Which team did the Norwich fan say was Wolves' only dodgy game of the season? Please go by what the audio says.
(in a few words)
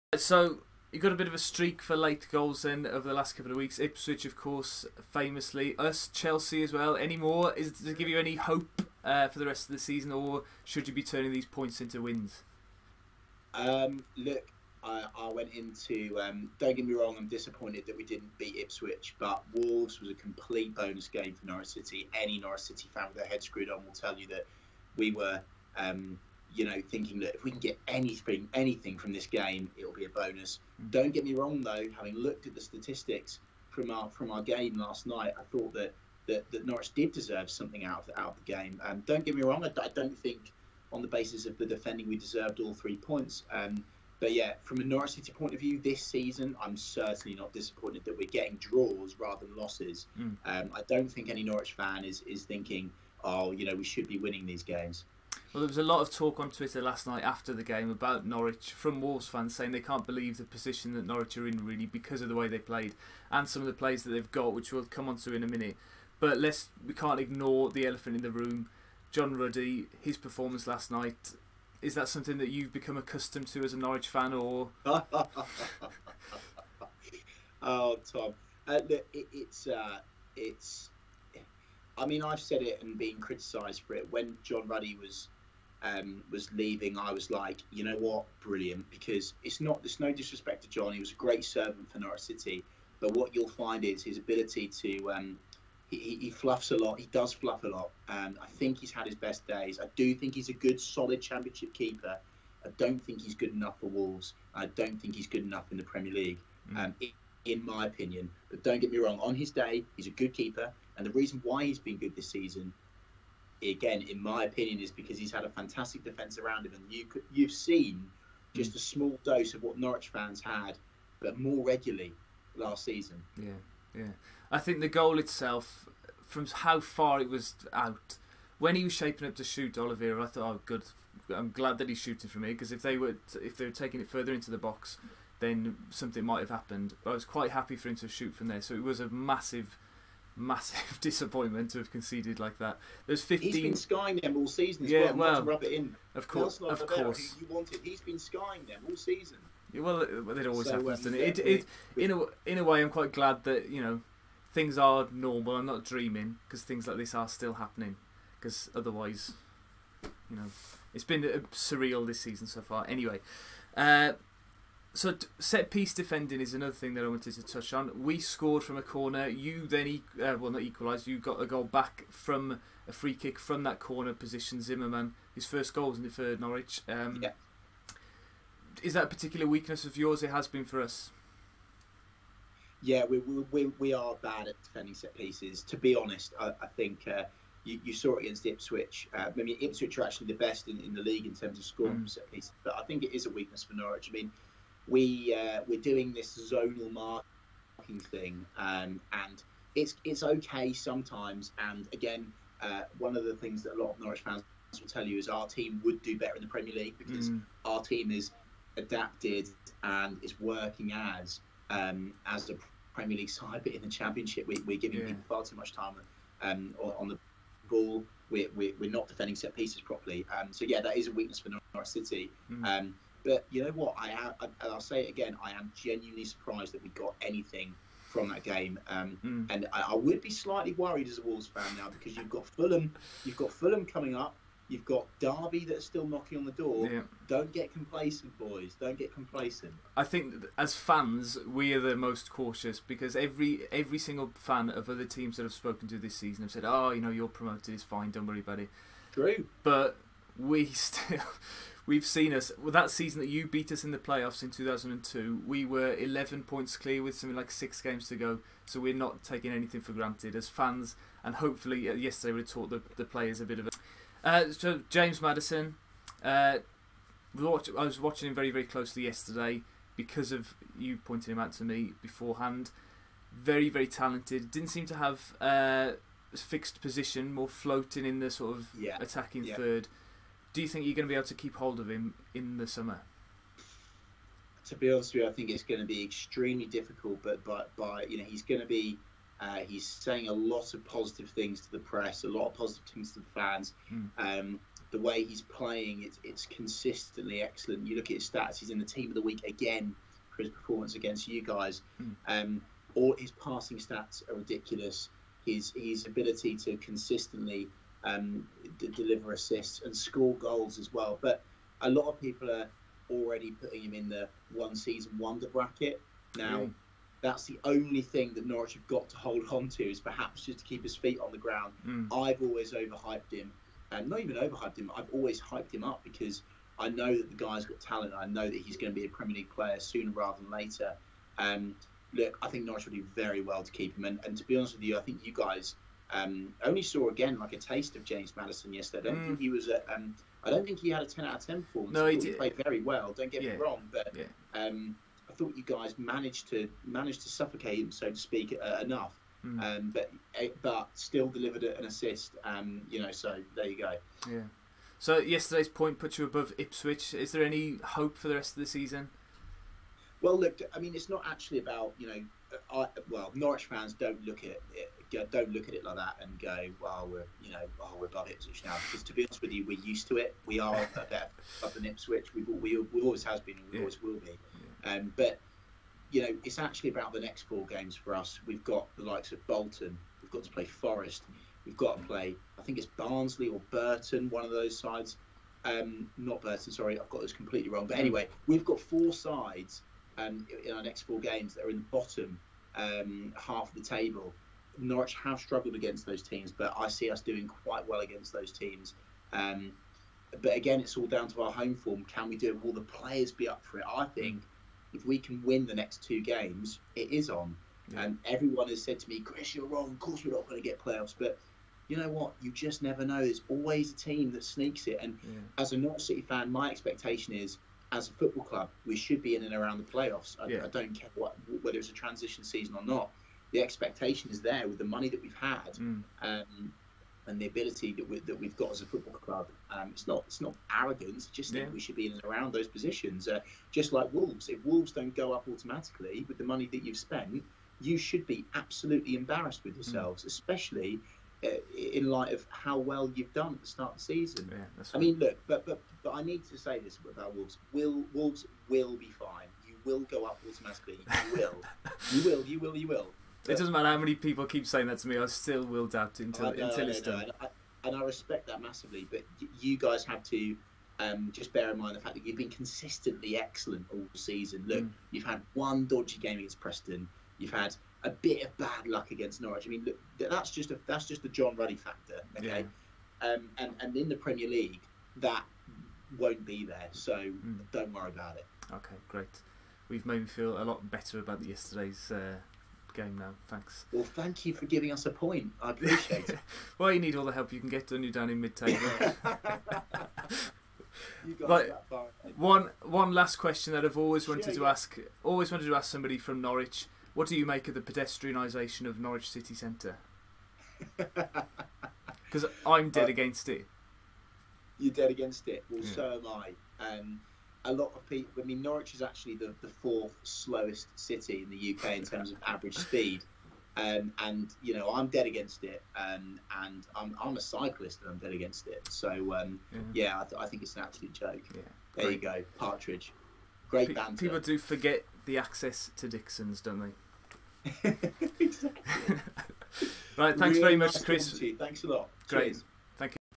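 Preston.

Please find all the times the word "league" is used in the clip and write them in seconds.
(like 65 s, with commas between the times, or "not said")
106 s, 191 s, 206 s, 213 s, 329 s, 474 s.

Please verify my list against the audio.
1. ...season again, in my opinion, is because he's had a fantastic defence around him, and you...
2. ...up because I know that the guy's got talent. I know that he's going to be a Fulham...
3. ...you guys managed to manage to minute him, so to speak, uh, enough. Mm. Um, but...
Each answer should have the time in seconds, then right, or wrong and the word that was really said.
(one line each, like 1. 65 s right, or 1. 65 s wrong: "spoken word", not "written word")
1. 112 s right
2. 325 s wrong: "Premier", not "Fulham"
3. 345 s wrong: "suffocate", not "minute".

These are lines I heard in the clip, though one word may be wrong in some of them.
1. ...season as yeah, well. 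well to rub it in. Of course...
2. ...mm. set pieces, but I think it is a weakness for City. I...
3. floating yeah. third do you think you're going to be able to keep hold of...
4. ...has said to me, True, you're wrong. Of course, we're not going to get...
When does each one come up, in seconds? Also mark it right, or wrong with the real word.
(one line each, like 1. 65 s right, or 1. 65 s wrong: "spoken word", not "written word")
1. 144 s right
2. 191 s wrong: "Norwich", not "City"
3. 278 s wrong: "attacking", not "floating"
4. 408 s wrong: "Chris", not "True".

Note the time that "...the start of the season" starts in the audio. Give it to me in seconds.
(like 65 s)
443 s.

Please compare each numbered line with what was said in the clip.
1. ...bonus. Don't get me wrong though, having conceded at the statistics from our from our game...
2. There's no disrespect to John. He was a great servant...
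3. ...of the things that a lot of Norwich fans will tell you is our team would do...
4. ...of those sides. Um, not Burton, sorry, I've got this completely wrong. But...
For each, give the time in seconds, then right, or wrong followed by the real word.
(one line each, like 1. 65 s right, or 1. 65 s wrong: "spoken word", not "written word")
1. 30 s wrong: "looked", not "conceded"
2. 89 s right
3. 203 s right
4. 384 s right.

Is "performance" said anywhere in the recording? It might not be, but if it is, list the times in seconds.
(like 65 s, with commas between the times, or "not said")
70 s, 300 s, 341 s.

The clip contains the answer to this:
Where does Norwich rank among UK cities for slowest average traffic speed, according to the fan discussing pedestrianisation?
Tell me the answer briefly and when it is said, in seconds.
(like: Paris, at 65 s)
Fourth slowest, at 509 s.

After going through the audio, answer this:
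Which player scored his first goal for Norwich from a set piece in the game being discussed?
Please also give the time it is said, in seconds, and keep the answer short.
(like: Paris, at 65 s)
Zimmerman, at 174 s.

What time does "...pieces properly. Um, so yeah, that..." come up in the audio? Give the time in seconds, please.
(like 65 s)
219 s.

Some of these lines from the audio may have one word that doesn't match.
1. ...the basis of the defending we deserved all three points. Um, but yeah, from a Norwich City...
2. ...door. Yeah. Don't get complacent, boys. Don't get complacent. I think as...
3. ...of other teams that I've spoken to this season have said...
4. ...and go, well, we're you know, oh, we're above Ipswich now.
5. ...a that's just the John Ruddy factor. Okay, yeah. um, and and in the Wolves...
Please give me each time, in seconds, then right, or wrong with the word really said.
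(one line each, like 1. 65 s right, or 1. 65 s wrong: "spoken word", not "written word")
1. 41 s right
2. 236 s right
3. 244 s right
4. 366 s right
5. 470 s wrong: "Premier", not "Wolves".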